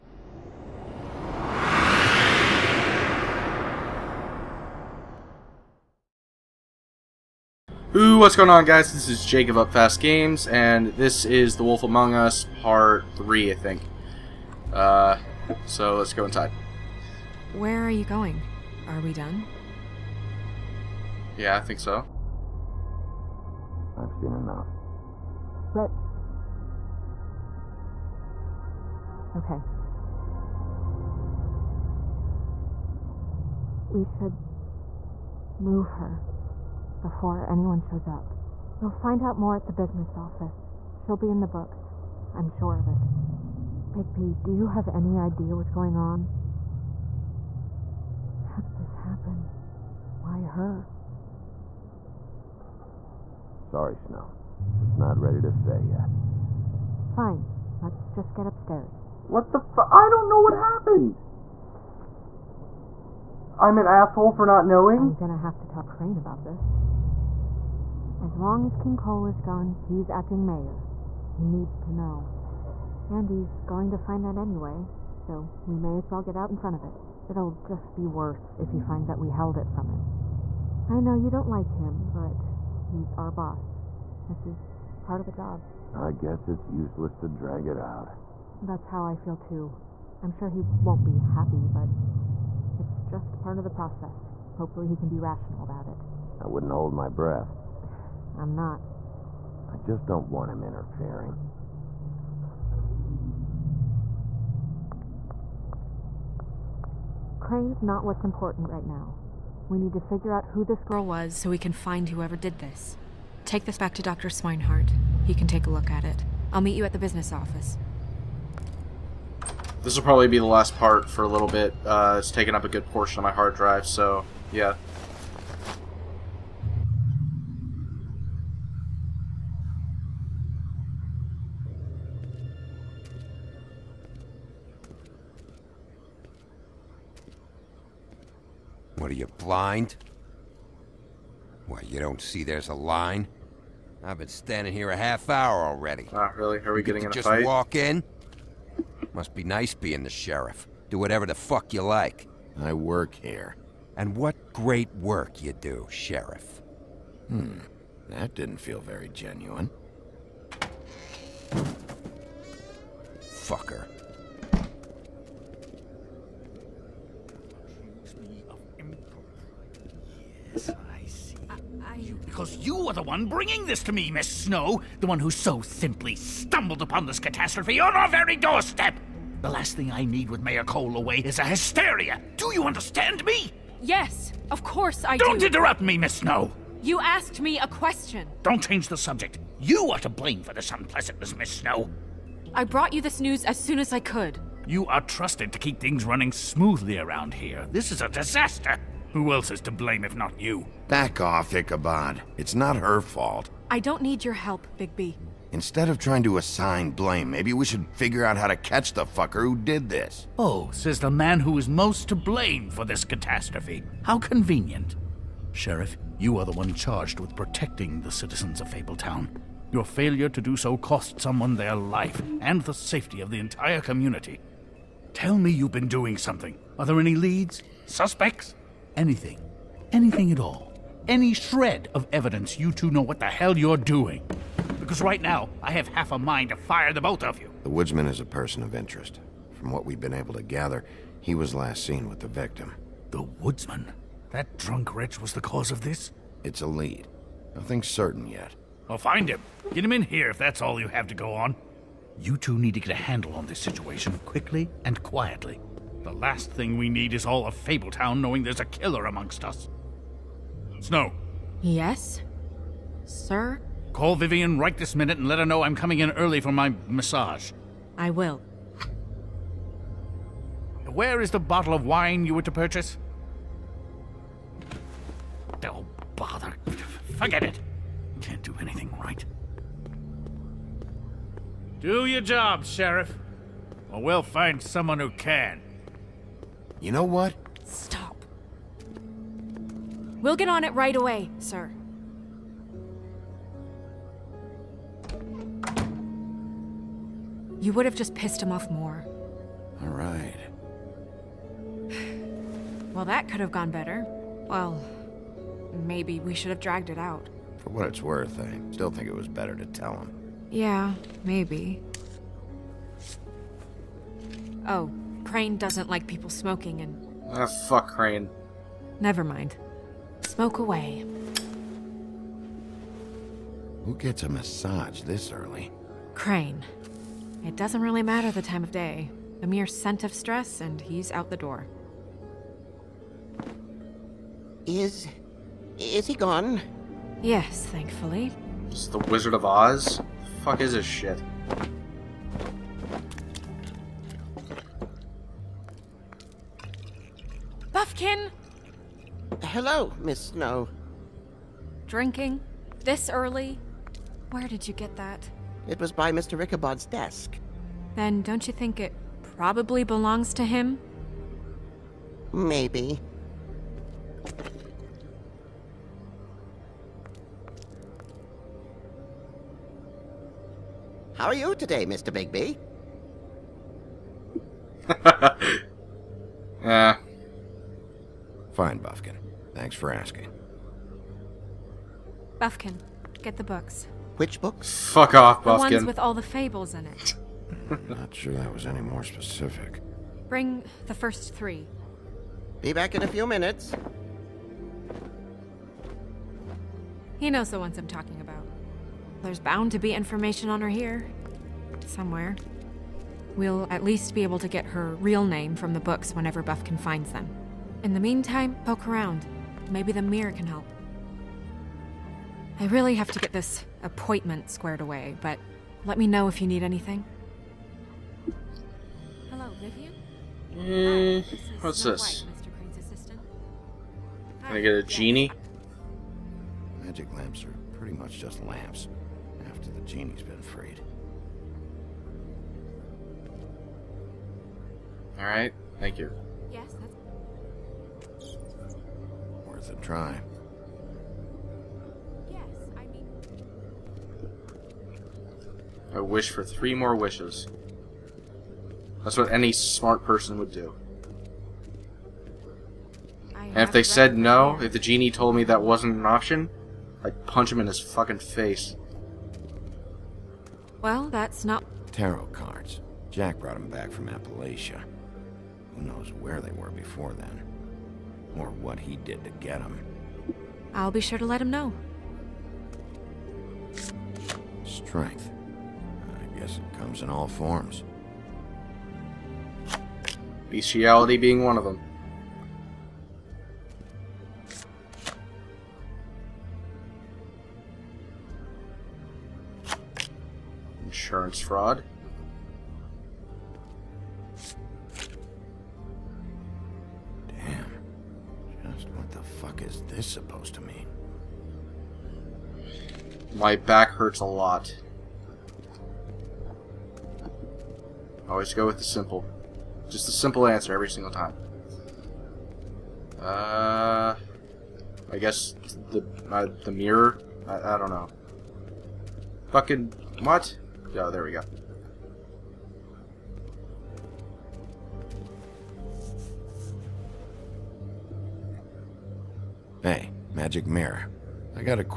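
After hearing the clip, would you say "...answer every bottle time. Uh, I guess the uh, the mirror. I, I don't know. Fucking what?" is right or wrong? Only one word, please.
wrong.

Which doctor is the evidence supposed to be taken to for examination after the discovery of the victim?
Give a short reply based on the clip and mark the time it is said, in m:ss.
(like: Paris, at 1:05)
Dr. Swineheart, at 1:54.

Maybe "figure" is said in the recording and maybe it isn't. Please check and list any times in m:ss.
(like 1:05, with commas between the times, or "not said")
1:49, 3:27.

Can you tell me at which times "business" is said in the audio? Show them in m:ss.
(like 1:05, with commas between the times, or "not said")
0:39, 1:56.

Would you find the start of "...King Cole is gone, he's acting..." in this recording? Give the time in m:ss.
1:08.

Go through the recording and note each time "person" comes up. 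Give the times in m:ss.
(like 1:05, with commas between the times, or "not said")
3:58, 7:30.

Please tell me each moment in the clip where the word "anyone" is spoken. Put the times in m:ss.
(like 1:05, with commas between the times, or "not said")
0:37.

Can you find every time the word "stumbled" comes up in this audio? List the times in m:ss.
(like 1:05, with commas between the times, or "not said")
2:56.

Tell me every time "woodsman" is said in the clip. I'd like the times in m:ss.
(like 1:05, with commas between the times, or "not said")
3:57, 4:03.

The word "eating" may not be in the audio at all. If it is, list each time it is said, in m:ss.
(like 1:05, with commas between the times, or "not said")
not said.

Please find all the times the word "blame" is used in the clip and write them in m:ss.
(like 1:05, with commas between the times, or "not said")
3:10, 3:19, 3:26, 3:32.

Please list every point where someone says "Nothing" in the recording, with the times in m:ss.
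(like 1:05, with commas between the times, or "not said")
4:07.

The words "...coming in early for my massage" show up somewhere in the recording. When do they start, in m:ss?
4:25.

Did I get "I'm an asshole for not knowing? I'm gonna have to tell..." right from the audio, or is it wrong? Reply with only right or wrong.
right.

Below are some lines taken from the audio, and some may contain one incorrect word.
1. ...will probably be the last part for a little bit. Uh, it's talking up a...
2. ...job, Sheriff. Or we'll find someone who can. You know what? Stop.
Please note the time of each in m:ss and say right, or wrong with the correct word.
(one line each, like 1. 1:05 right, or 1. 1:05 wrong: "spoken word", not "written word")
1. 1:59 wrong: "taking", not "talking"
2. 4:42 right.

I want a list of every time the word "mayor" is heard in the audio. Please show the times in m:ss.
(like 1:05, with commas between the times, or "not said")
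1:10, 3:00.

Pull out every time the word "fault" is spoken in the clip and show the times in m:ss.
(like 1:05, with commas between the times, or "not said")
3:23.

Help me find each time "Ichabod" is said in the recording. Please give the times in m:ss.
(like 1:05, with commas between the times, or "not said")
3:21, 5:56.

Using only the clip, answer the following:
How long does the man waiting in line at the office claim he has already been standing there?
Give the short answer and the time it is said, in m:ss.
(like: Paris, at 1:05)
a half hour, at 2:24.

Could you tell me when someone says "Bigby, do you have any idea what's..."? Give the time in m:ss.
0:43.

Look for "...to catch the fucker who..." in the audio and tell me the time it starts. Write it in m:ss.
3:28.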